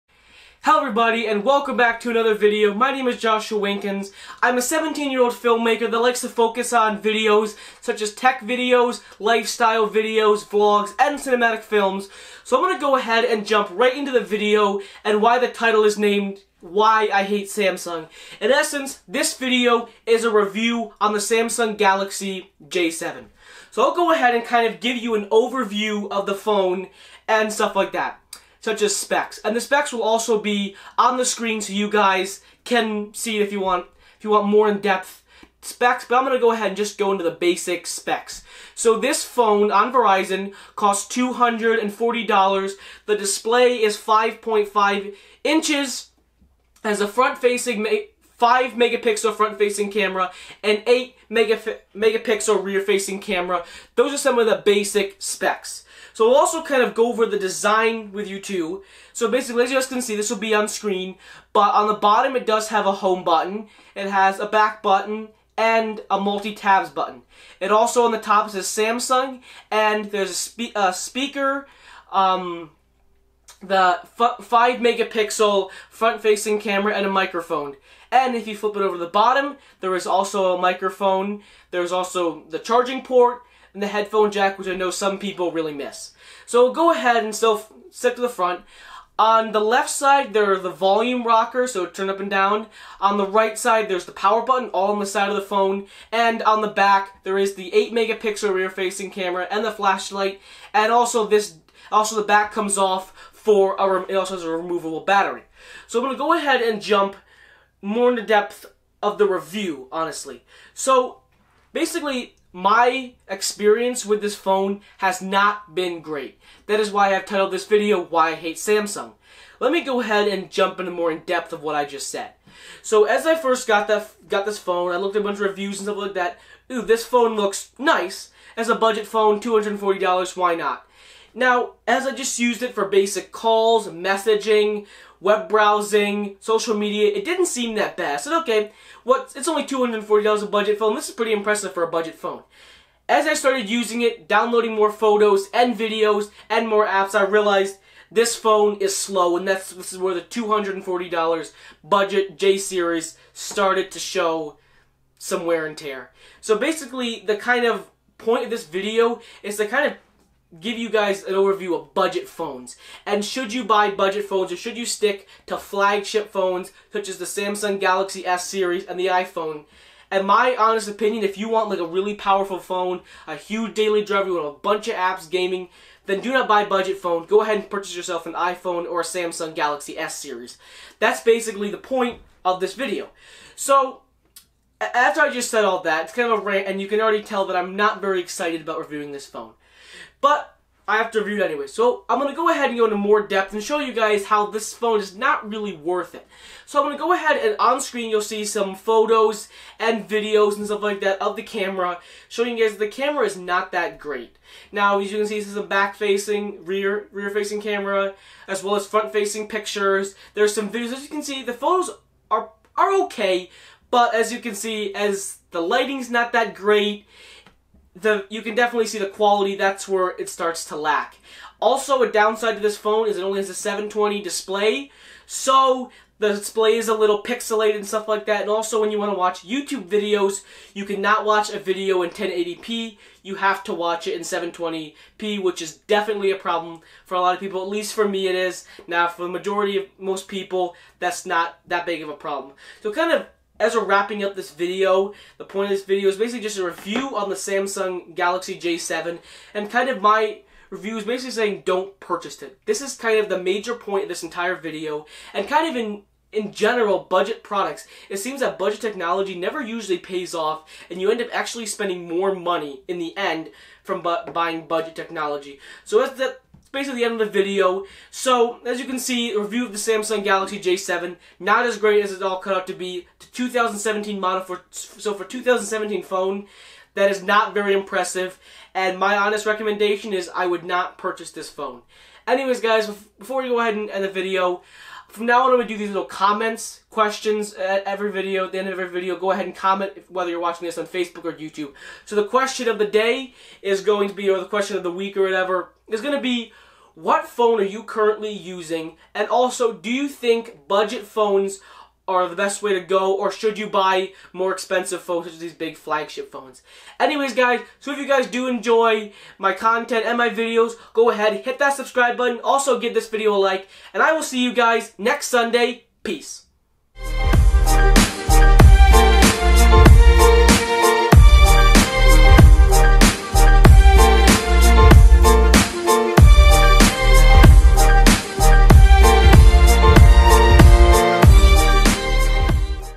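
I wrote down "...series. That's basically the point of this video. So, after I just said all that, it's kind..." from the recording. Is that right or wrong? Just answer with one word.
right.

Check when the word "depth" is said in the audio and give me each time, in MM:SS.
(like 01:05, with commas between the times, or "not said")
00:34, 01:48, 02:01, 03:13.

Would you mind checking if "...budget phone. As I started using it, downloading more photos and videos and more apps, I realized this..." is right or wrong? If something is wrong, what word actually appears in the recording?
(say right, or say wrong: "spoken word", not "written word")
right.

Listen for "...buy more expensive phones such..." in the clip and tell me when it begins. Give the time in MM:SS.
05:03.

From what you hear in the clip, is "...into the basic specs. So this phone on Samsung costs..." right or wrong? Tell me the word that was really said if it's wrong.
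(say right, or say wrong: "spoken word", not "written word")
wrong: "Verizon", not "Samsung".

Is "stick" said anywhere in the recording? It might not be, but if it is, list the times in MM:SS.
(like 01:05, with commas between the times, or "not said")
01:27, 02:44.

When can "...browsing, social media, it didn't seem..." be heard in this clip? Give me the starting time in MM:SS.
02:15.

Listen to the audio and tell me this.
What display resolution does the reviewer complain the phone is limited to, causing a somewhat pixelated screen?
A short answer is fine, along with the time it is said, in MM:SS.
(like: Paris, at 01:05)
720, at 03:43.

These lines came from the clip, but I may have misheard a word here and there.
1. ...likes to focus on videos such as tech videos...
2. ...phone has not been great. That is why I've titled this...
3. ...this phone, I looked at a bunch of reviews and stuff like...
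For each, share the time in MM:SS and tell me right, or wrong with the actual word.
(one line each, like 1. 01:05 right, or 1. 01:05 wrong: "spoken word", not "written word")
1. 00:05 right
2. 01:54 right
3. 02:04 right.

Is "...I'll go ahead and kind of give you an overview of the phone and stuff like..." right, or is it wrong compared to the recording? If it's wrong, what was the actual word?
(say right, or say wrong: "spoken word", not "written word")
right.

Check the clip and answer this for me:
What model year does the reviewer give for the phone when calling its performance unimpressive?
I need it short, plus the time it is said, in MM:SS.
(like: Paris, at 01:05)
2017, at 04:33.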